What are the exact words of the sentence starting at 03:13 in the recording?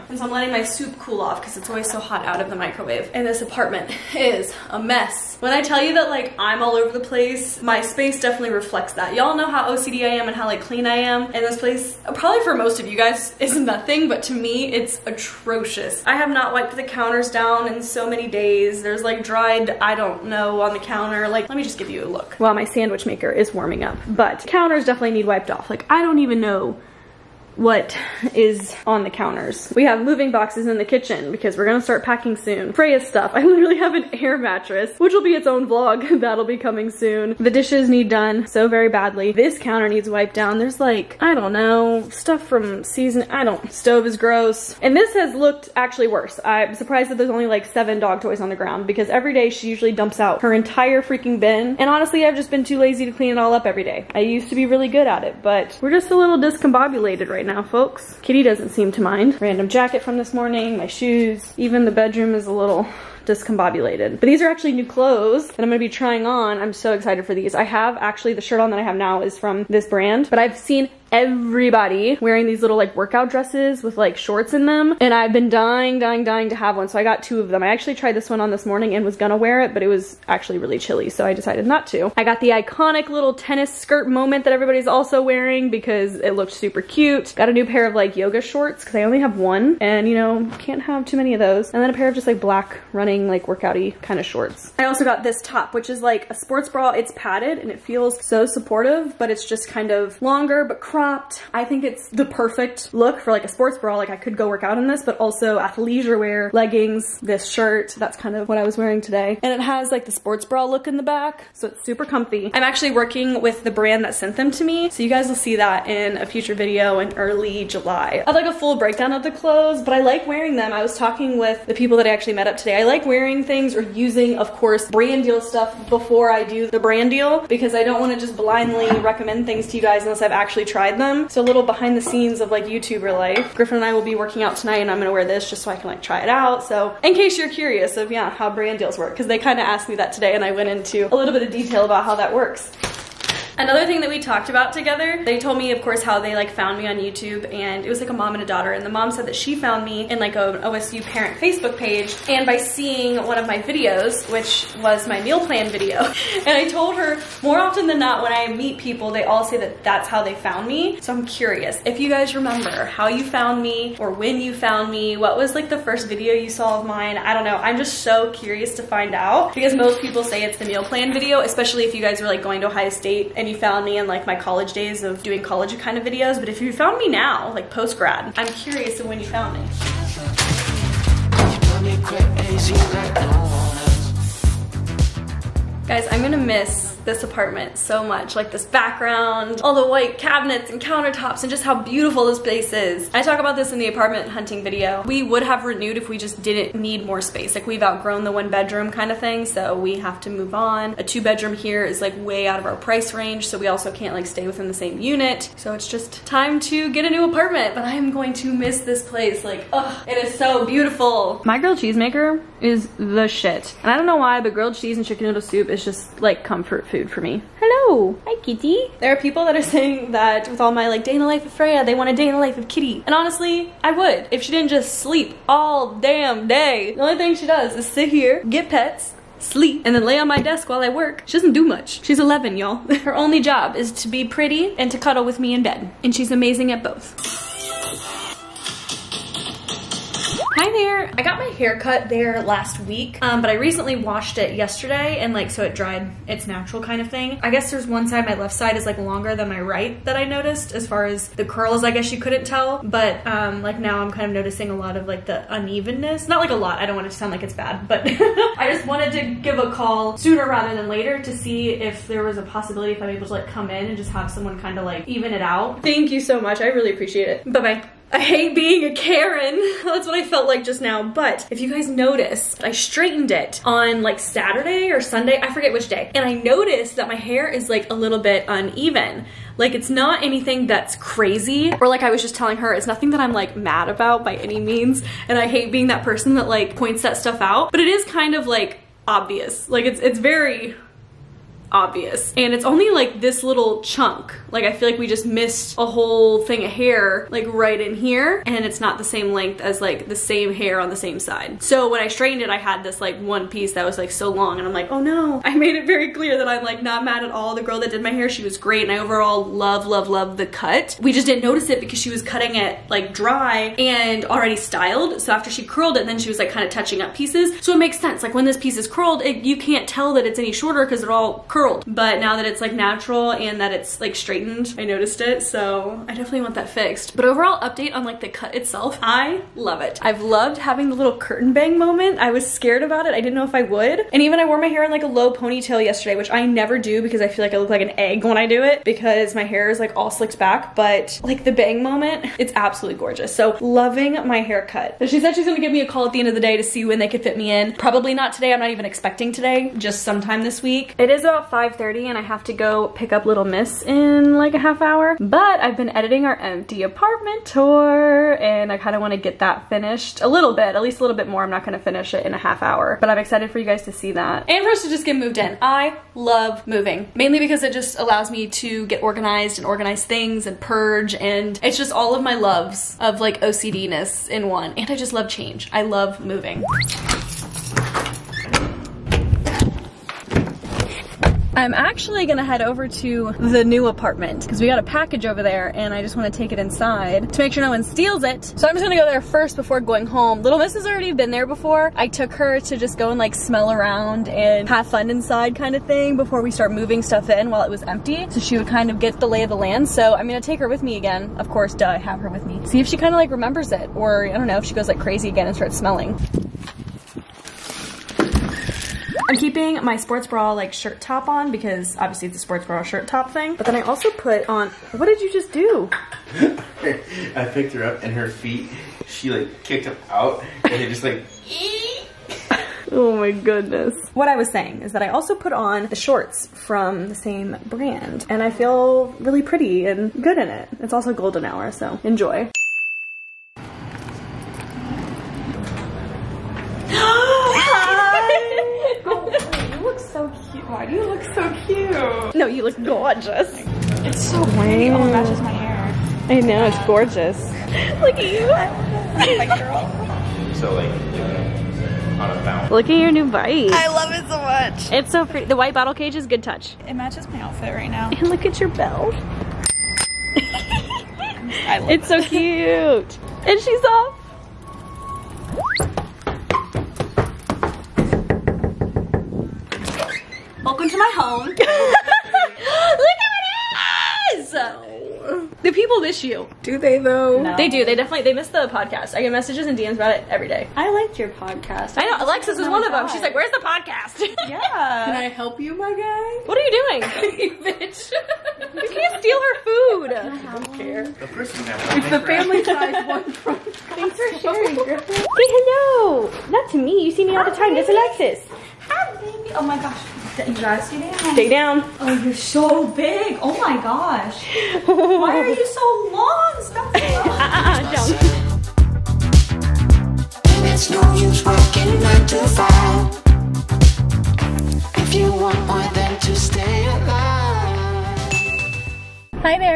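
I talk about this in the apartment hunting video.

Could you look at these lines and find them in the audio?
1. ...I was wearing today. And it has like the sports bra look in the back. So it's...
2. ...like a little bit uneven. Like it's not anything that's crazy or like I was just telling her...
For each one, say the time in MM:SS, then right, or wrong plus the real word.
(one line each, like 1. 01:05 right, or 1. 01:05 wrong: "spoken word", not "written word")
1. 01:48 right
2. 04:37 right.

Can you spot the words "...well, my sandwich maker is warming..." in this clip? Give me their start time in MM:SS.
00:22.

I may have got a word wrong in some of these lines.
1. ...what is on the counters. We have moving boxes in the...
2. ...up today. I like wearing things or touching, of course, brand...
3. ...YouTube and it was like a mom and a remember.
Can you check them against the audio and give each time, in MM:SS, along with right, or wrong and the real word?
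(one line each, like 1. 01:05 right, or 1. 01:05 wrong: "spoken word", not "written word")
1. 00:27 right
2. 02:02 wrong: "using", not "touching"
3. 02:26 wrong: "daughter", not "remember".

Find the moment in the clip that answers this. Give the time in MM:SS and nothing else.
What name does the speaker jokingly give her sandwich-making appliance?
03:31.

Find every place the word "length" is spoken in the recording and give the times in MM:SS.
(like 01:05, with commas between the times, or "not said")
04:59.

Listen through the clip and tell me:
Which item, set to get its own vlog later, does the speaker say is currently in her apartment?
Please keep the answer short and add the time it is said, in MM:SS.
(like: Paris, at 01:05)
air mattress, at 00:34.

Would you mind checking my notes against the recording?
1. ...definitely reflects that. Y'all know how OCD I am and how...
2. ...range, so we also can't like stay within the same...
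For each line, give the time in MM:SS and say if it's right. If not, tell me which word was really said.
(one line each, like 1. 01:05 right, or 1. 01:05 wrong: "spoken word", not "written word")
1. 00:08 right
2. 03:23 right.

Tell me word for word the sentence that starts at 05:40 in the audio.
But like the bang moment, it's absolutely gorgeous.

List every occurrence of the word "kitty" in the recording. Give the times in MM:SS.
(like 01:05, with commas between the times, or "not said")
00:58, 03:38, 03:42.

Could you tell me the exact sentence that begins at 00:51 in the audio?
And honestly, I've just been too lazy to clean it all up every day.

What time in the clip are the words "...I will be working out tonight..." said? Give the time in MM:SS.
02:13.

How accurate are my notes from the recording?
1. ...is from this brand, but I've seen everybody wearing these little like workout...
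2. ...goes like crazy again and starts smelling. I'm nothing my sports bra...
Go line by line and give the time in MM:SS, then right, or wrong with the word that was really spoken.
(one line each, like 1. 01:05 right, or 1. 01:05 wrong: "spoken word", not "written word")
1. 01:09 right
2. 06:44 wrong: "keeping", not "nothing".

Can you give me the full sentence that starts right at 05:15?
So after she curled it, then she was like kind of touching up pieces.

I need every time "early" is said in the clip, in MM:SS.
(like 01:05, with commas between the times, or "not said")
01:57.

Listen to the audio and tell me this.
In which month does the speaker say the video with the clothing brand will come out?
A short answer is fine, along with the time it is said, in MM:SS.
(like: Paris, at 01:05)
July, at 01:57.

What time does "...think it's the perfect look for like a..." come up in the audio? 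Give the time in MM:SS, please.
01:41.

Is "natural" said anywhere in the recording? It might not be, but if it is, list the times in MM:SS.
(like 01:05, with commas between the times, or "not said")
04:06, 05:22.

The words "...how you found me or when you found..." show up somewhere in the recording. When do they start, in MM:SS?
02:42.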